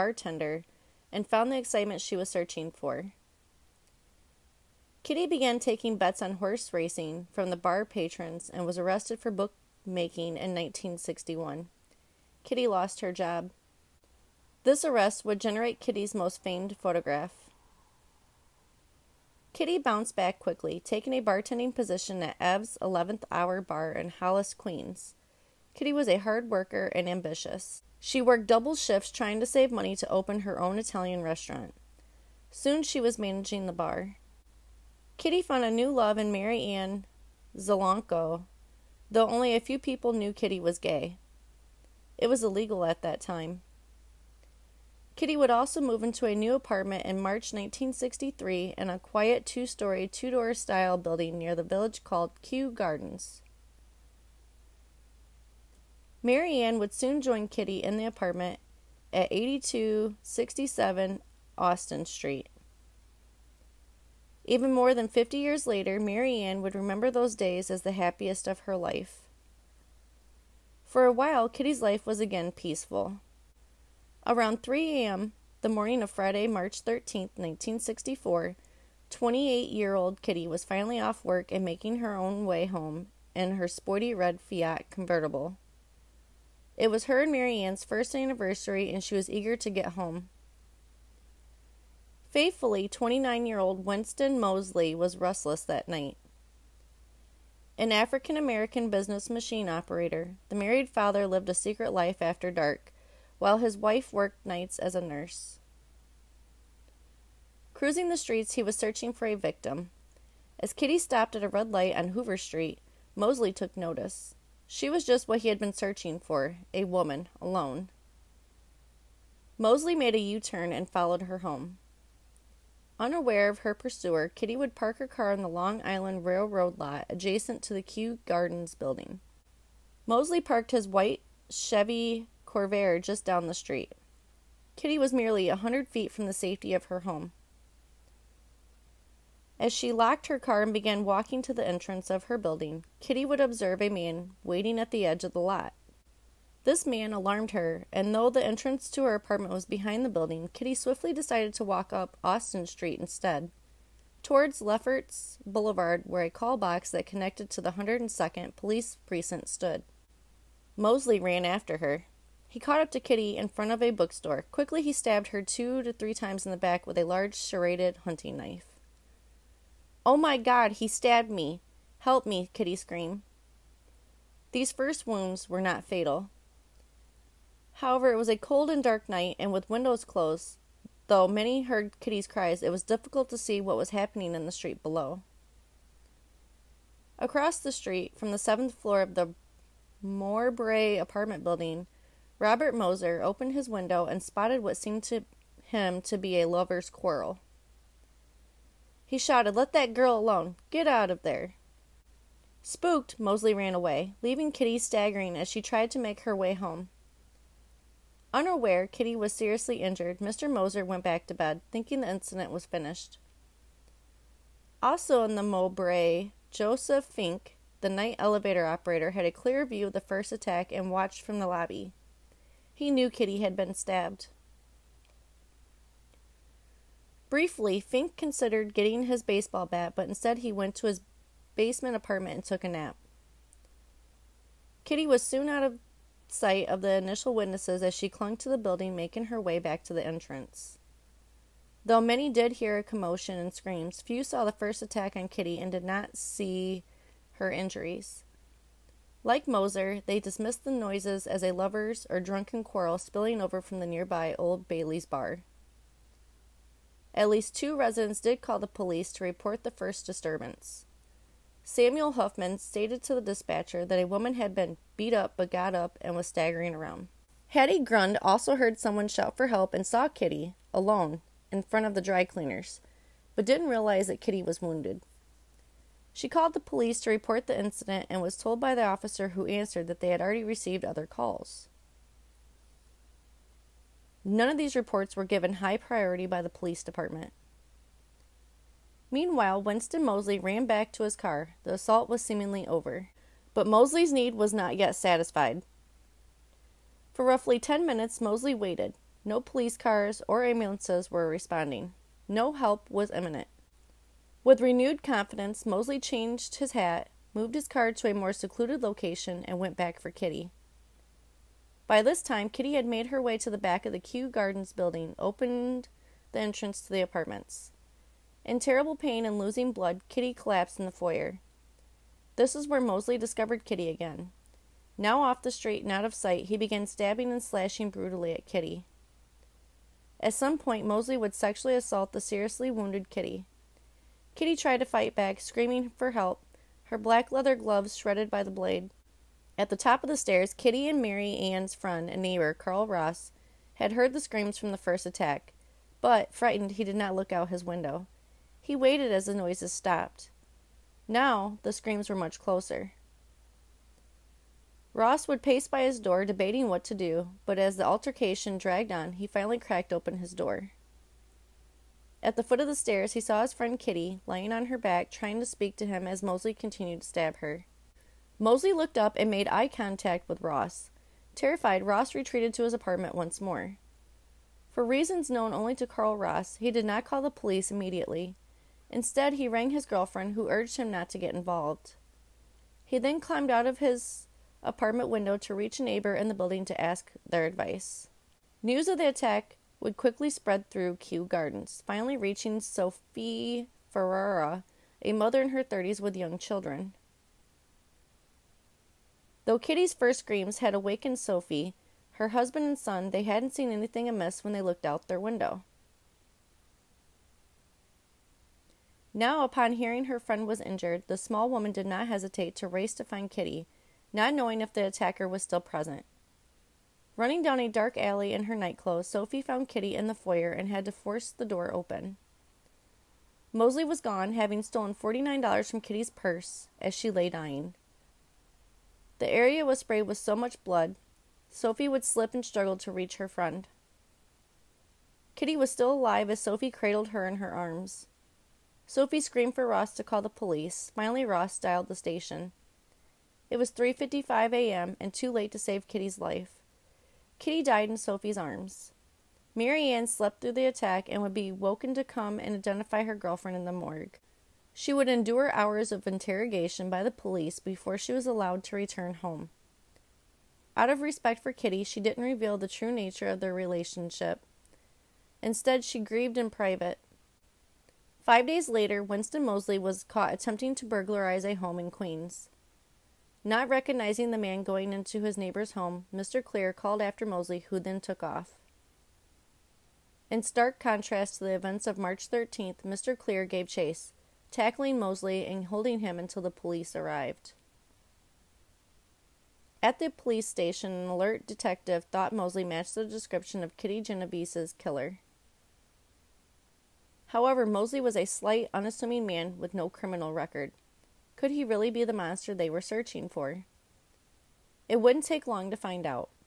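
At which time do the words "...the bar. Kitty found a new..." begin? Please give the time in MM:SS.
00:33.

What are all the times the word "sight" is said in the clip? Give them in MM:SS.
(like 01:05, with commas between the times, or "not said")
03:56, 05:26.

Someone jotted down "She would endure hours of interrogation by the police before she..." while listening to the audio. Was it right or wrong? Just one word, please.
right.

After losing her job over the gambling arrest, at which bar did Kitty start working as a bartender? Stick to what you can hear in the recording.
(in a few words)
Ev's 11th Hour Bar.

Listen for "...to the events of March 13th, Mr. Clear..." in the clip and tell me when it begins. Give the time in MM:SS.
08:01.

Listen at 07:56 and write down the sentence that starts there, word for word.
Clear called after Moseley, who then took off.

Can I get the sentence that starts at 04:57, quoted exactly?
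For roughly 10 minutes, Moseley waited.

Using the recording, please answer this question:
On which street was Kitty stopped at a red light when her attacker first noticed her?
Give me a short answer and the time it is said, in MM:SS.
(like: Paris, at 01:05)
Hoover Street, at 01:52.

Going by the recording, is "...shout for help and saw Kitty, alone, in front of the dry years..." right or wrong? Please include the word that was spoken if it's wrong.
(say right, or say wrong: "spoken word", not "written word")
wrong: "cleaners", not "years".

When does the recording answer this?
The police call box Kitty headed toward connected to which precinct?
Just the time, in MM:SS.
02:37.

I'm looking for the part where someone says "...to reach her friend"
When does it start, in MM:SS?
07:12.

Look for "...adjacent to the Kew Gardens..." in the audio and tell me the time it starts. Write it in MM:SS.
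02:07.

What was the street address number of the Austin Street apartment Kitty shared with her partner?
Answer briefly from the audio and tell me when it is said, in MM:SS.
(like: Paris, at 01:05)
8267, at 00:59.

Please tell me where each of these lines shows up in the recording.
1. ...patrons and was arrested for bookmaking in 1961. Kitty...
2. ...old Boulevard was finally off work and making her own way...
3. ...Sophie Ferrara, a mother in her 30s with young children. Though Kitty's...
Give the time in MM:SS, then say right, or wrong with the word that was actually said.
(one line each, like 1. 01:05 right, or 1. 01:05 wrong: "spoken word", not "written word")
1. 00:07 right
2. 01:19 wrong: "Kitty", not "Boulevard"
3. 06:32 right.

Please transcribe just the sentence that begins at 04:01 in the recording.
Though many did hear a commotion and screams, few saw the first attack on Kitty and did not see her injuries.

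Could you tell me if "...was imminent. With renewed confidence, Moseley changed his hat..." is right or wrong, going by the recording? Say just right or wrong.
right.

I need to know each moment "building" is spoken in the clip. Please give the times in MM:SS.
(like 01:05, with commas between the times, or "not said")
00:50, 02:08, 02:22, 02:30, 03:11, 03:58, 05:14, 06:26.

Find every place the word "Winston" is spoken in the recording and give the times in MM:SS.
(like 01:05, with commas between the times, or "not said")
01:33, 04:49, 07:49.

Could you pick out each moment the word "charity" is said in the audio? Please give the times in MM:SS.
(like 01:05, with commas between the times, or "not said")
not said.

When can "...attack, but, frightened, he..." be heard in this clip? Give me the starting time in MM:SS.
05:45.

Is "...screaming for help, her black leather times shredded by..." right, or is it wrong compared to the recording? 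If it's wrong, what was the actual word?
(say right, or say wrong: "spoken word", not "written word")
wrong: "gloves", not "times".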